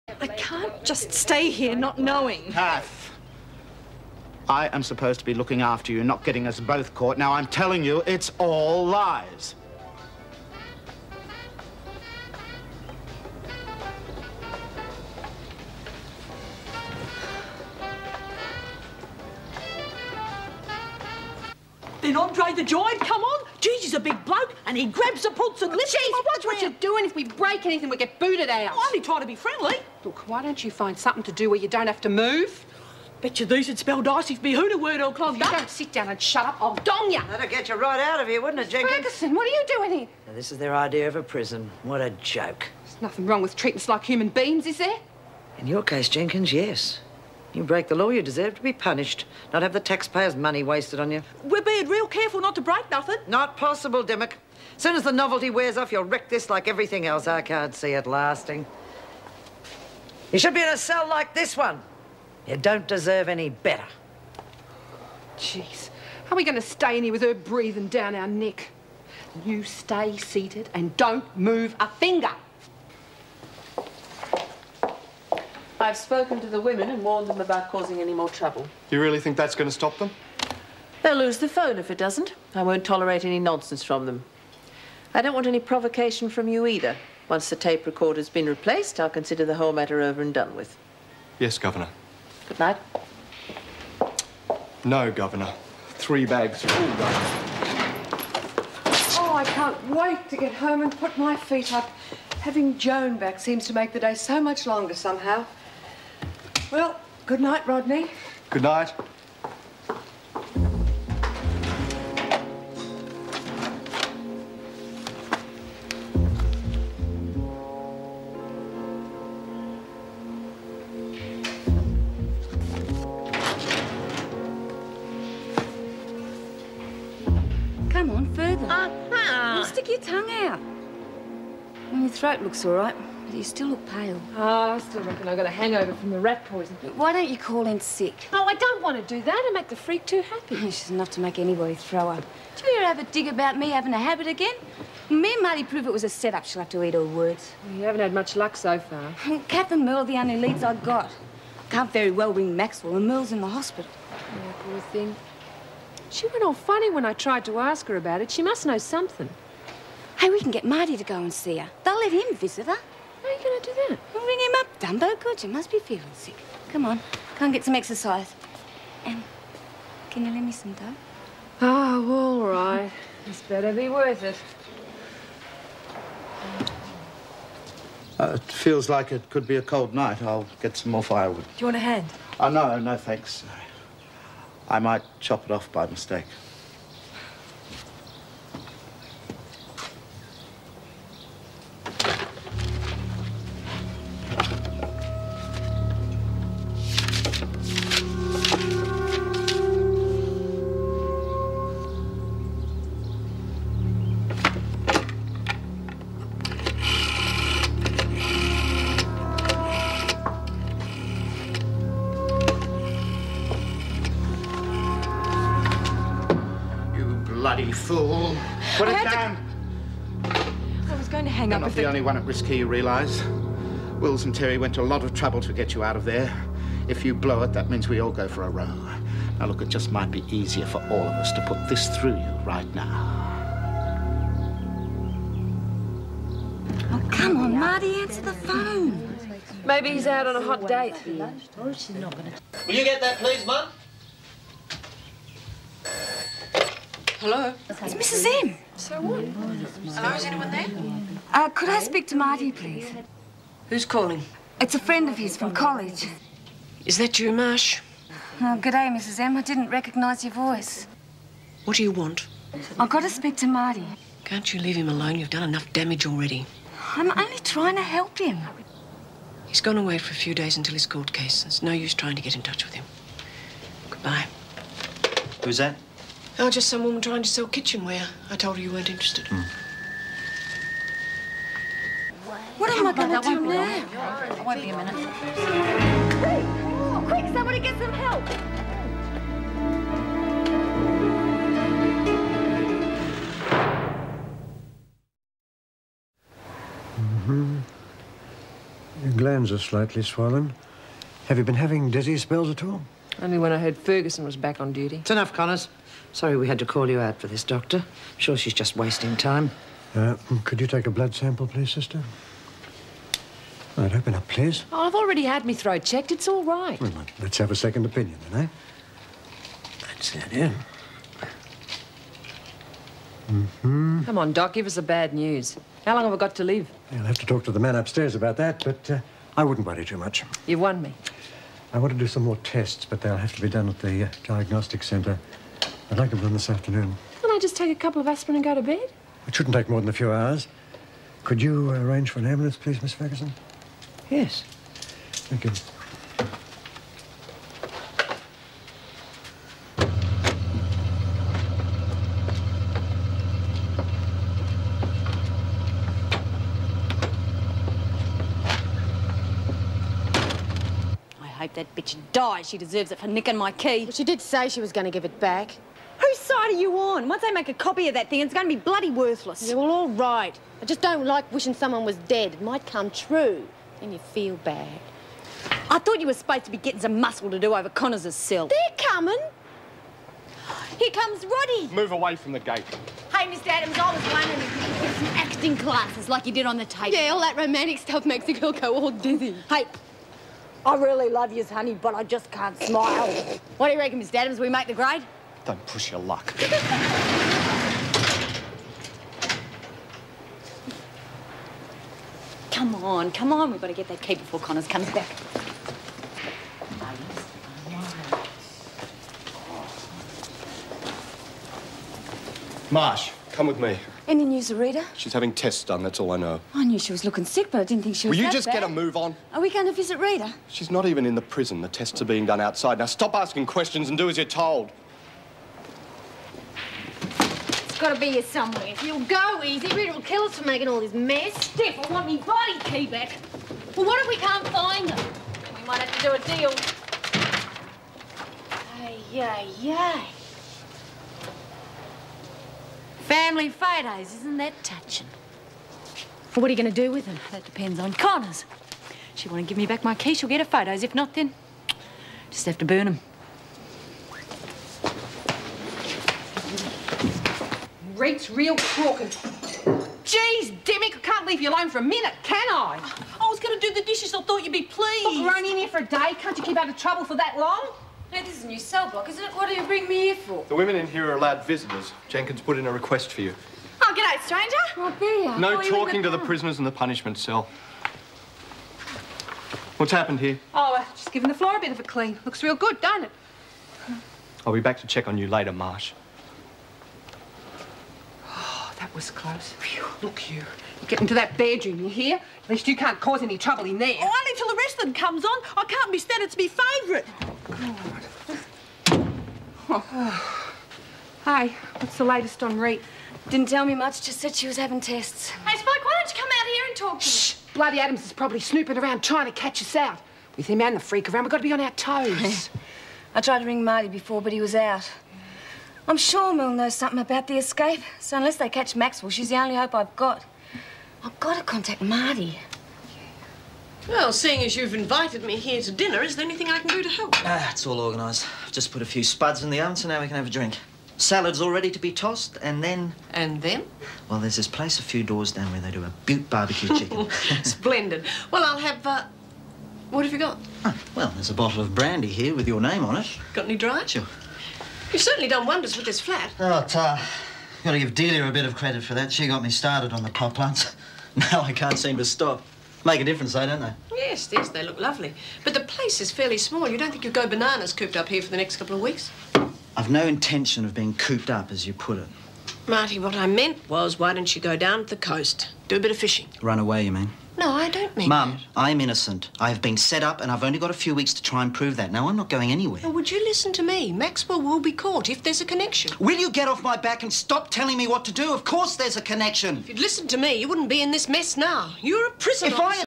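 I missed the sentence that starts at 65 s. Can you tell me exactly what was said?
Jeez, are we going to stay in here with her breathing down our neck?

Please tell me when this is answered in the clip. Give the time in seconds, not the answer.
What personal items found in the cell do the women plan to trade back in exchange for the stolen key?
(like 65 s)
443 s.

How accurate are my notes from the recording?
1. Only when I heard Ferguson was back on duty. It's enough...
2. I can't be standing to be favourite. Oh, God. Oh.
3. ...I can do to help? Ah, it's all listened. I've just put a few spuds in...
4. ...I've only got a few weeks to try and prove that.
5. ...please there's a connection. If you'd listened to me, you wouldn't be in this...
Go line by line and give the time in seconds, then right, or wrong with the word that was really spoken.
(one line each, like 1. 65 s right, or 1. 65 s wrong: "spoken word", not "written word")
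1. 303 s right
2. 495 s right
3. 526 s wrong: "organised", not "listened"
4. 570 s right
5. 578 s wrong: "course", not "please".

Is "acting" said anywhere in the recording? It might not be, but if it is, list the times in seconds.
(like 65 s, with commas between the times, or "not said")
385 s.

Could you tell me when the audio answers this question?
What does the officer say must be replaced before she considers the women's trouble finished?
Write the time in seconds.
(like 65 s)
87 s.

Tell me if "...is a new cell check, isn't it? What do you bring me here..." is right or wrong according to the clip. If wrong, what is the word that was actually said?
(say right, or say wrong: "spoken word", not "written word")
wrong: "block", not "check".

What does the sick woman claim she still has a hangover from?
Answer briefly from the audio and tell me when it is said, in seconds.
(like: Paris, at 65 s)
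Rat poison, at 136 s.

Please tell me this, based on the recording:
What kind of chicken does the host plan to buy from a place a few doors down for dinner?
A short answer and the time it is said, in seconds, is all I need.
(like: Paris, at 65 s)
Barbecue chicken, at 536 s.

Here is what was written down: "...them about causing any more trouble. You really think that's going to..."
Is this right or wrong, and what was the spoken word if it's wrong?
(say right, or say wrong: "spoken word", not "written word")
right.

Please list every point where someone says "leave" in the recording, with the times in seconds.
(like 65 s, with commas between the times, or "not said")
264 s, 461 s.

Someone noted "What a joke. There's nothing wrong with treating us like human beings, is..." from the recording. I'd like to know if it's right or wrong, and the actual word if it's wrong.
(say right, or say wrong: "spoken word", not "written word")
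right.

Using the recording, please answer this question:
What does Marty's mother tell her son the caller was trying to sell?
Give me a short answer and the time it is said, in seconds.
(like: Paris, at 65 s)
Kitchenware, at 277 s.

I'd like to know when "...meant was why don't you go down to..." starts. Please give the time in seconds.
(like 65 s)
563 s.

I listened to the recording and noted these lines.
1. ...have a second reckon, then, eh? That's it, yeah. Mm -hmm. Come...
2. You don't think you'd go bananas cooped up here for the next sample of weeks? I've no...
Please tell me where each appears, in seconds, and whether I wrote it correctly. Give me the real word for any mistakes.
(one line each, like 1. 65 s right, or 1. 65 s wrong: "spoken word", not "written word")
1. 317 s wrong: "opinion", not "reckon"
2. 556 s wrong: "couple", not "sample".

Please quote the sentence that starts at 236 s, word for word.
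Oh, come on, Marty, answer the phone.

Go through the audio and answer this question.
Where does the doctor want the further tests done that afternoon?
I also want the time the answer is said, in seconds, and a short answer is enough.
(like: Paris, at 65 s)
Diagnostic centre, at 334 s.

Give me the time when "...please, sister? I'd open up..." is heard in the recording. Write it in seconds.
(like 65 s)
311 s.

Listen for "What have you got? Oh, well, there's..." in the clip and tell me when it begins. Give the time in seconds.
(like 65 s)
539 s.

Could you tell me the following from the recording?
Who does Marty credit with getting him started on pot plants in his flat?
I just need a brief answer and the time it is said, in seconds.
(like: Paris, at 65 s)
Delia, at 547 s.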